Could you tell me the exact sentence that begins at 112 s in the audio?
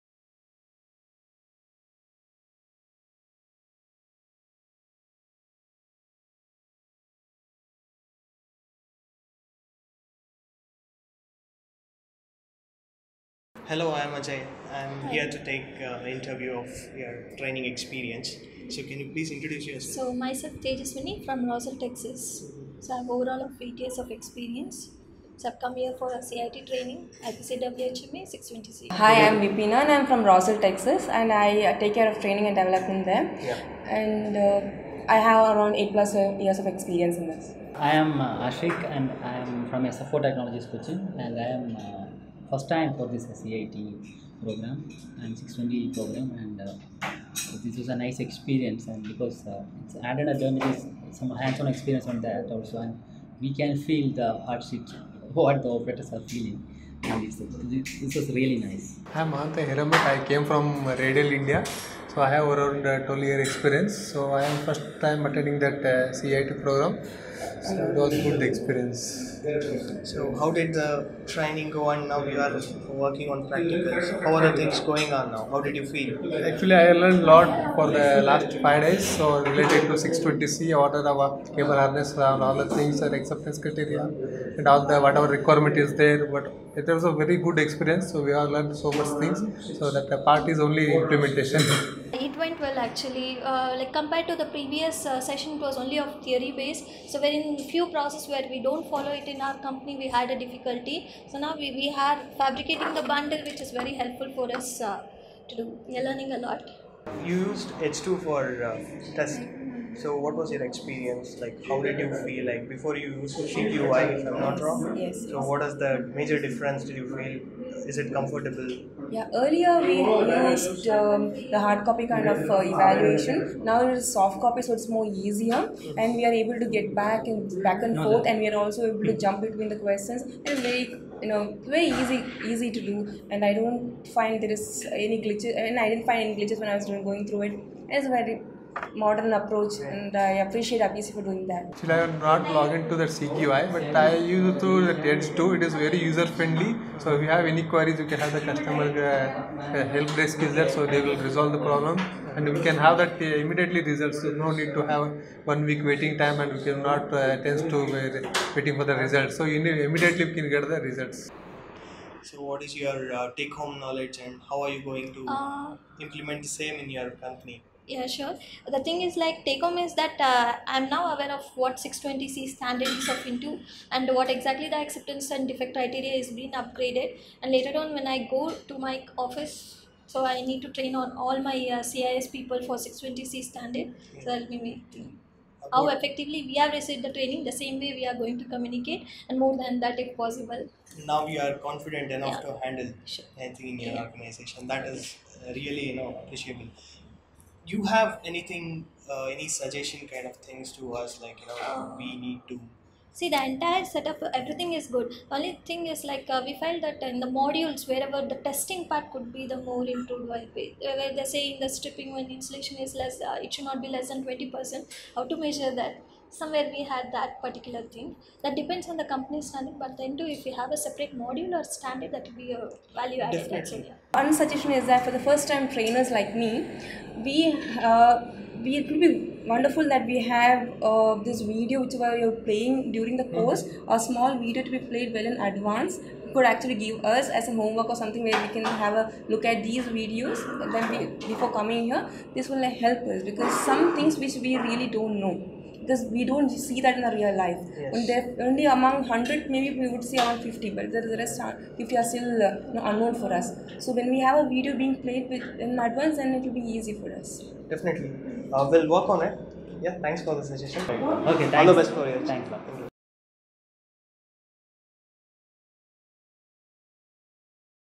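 Like, before you used to shake if I'm not wrong.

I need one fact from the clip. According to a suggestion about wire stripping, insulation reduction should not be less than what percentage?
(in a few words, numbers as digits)
20%.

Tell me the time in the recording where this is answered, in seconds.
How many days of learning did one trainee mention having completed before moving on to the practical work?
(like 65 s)
78 s.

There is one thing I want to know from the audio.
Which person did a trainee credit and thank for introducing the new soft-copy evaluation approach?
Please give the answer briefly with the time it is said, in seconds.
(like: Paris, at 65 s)
Abhishek, at 140 s.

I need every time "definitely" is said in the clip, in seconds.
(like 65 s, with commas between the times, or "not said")
223 s, 257 s.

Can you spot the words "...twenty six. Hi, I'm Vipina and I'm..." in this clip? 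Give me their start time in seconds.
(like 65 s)
28 s.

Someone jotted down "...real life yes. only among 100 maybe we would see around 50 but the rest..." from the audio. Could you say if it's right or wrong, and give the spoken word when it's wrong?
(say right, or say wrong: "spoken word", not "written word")
right.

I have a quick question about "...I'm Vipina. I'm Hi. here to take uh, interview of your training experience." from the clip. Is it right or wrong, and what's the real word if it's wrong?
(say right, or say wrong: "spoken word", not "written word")
wrong: "Ajay", not "Vipina".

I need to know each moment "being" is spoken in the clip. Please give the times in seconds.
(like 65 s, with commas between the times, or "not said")
176 s, 254 s.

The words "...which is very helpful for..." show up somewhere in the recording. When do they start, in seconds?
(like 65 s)
103 s.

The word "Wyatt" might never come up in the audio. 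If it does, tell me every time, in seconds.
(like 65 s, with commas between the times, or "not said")
not said.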